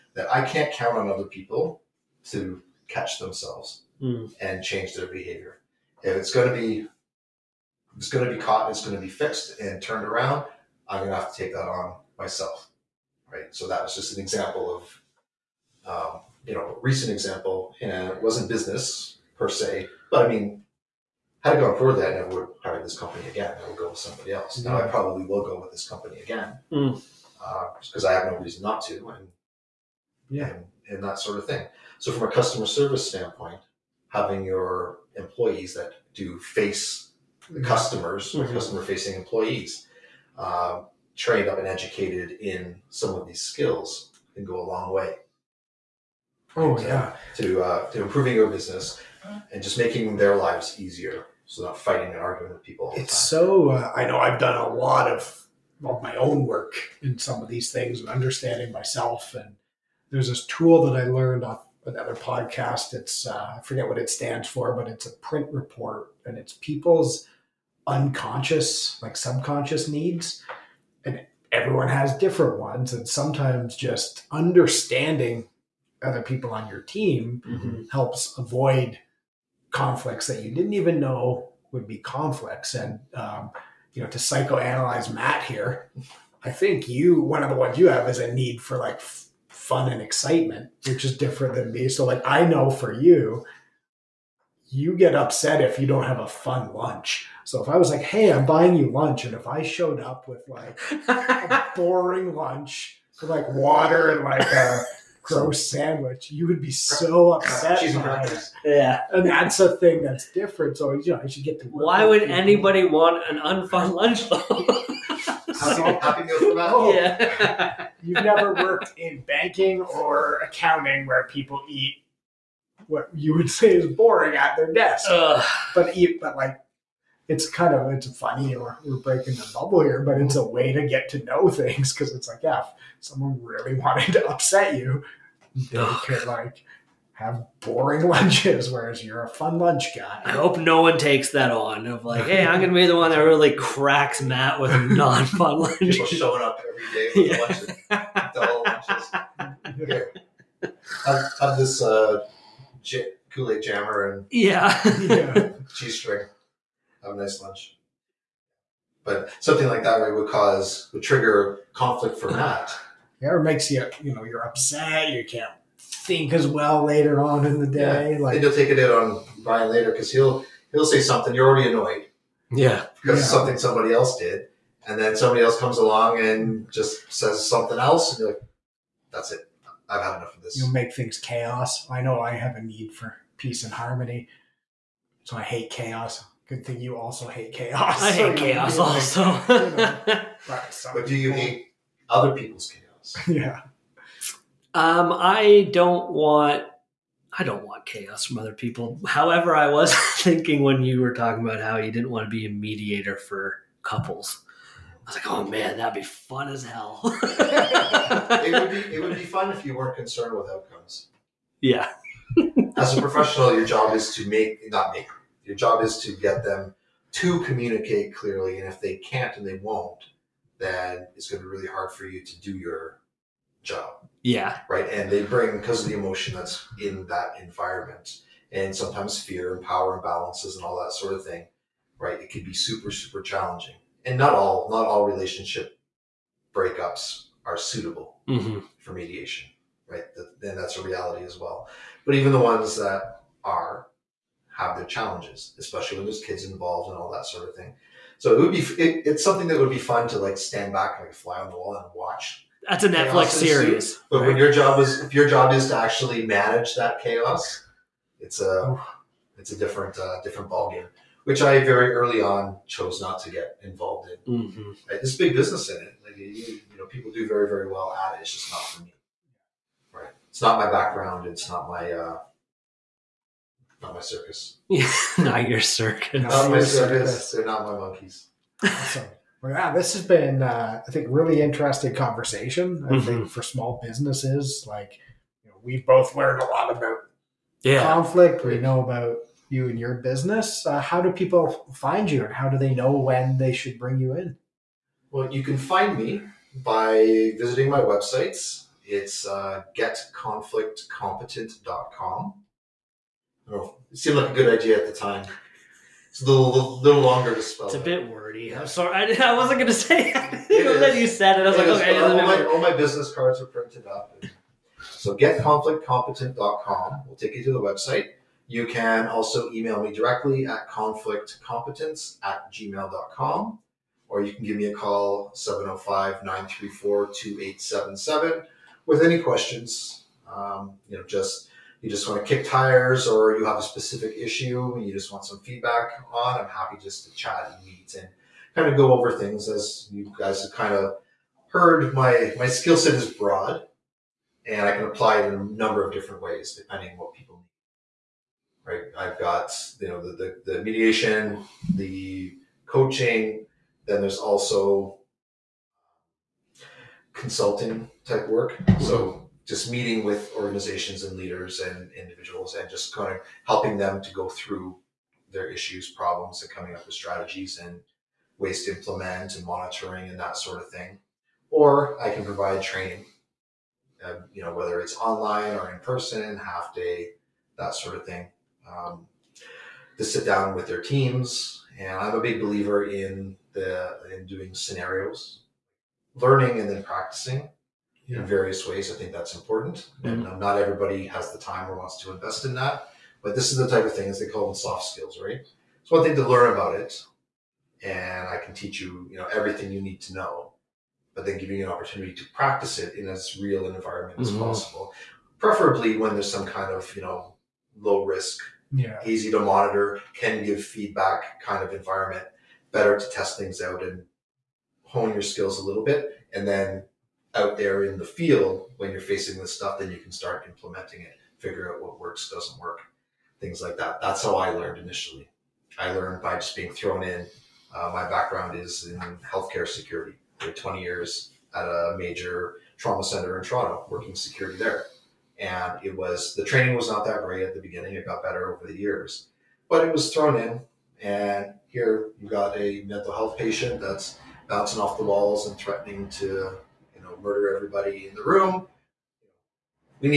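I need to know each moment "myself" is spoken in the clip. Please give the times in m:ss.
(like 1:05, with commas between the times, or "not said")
0:12, 0:58.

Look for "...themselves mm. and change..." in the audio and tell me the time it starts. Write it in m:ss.
0:03.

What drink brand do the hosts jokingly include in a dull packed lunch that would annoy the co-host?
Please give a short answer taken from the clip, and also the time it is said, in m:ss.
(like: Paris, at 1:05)
Kool-Aid Jammer, at 2:33.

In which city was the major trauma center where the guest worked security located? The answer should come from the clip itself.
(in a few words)
Toronto.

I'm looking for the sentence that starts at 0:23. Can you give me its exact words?
I would go with somebody else.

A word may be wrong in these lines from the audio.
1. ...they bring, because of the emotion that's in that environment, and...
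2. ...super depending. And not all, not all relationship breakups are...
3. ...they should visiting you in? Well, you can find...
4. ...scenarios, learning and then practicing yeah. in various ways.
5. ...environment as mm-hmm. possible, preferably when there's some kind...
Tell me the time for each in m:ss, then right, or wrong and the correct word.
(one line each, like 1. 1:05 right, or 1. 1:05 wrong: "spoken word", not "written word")
1. 3:45 right
2. 3:52 wrong: "challenging", not "depending"
3. 4:53 wrong: "bring", not "visiting"
4. 6:24 right
5. 6:43 right.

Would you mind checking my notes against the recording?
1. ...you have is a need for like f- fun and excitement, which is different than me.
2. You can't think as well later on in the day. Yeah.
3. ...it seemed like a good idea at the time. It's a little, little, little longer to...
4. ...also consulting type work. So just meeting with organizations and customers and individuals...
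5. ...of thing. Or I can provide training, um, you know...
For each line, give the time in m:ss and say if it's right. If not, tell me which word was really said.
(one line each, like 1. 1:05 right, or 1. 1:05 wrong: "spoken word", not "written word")
1. 1:27 right
2. 2:45 right
3. 5:03 right
4. 5:54 wrong: "leaders", not "customers"
5. 6:10 right.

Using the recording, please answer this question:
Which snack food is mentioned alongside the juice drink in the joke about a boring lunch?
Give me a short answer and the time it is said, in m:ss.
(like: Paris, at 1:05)
cheese string, at 2:35.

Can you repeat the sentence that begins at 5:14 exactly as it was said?
So getconflictcompetent.com will take you to the website.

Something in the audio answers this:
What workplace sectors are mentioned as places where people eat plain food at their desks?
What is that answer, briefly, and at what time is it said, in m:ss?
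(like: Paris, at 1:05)
banking or accounting, at 1:59.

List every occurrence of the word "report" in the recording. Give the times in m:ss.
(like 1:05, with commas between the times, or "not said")
1:05.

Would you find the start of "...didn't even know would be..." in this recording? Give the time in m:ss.
1:20.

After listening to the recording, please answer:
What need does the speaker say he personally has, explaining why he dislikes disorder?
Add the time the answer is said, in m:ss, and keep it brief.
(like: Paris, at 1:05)
peace and harmony, at 3:03.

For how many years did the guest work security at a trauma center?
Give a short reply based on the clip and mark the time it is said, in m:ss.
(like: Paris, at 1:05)
20, at 7:10.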